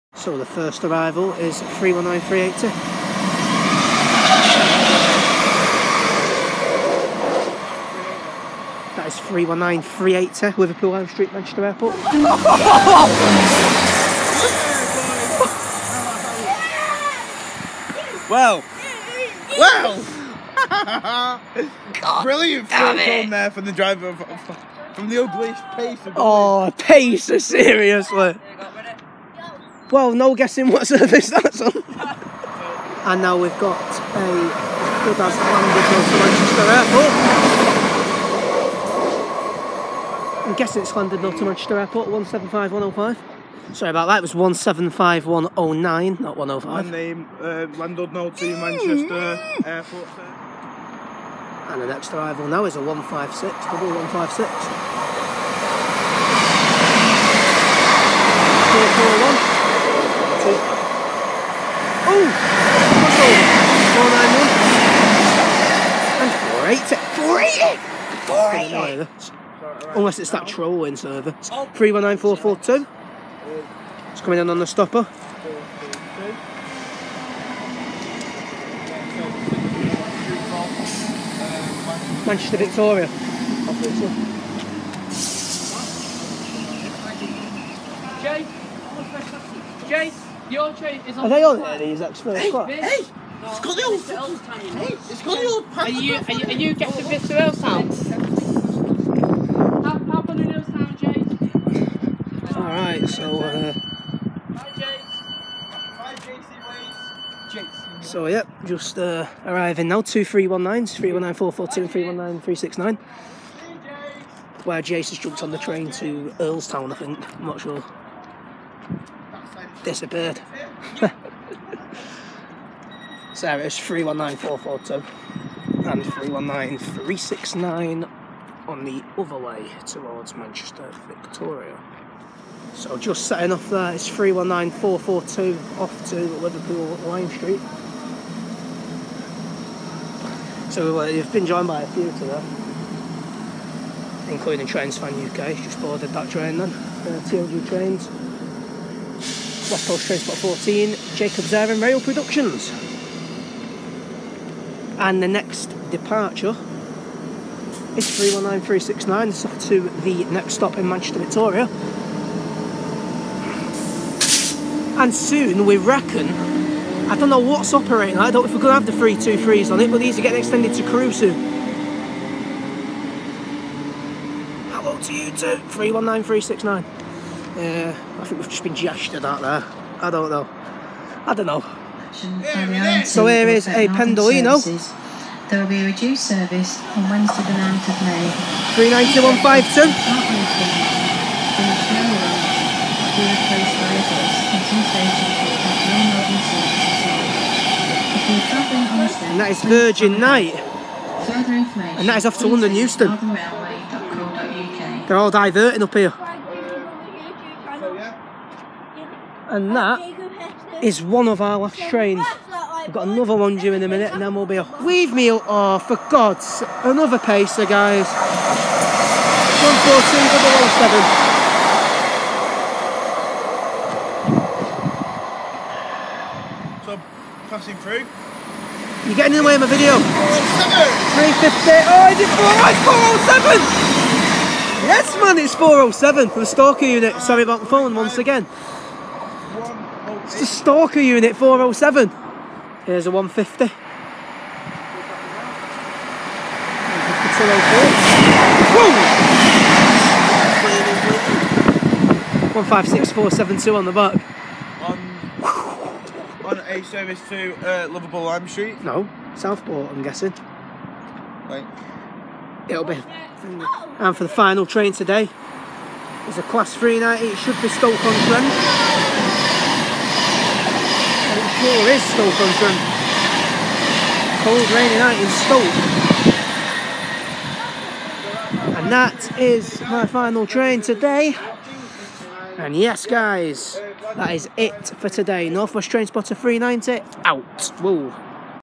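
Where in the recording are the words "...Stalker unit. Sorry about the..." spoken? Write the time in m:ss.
3:56.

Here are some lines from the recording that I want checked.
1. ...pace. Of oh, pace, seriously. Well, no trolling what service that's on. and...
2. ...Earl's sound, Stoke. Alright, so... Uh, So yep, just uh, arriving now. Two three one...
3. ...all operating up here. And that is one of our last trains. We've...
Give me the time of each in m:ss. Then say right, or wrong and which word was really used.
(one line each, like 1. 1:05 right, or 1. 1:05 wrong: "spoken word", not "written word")
1. 0:25 wrong: "guessing", not "trolling"
2. 1:40 wrong: "James", not "Stoke"
3. 3:25 wrong: "diverting", not "operating".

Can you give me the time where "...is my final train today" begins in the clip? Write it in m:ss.
4:39.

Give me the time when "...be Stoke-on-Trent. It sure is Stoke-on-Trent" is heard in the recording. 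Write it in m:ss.
4:27.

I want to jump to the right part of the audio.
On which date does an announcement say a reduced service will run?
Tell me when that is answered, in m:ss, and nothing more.
3:07.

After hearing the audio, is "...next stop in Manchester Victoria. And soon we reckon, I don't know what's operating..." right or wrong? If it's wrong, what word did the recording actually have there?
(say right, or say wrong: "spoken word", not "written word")
right.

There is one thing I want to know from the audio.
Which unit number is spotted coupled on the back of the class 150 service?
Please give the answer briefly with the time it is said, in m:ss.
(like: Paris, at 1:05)
156472, at 4:12.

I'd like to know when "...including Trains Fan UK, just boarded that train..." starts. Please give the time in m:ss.
2:24.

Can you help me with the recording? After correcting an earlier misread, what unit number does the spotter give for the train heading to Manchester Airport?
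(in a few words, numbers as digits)
175109.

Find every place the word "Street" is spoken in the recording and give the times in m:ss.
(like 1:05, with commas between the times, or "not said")
0:11, 2:17, 4:18.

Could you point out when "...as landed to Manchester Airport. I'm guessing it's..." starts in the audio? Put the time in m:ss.
0:35.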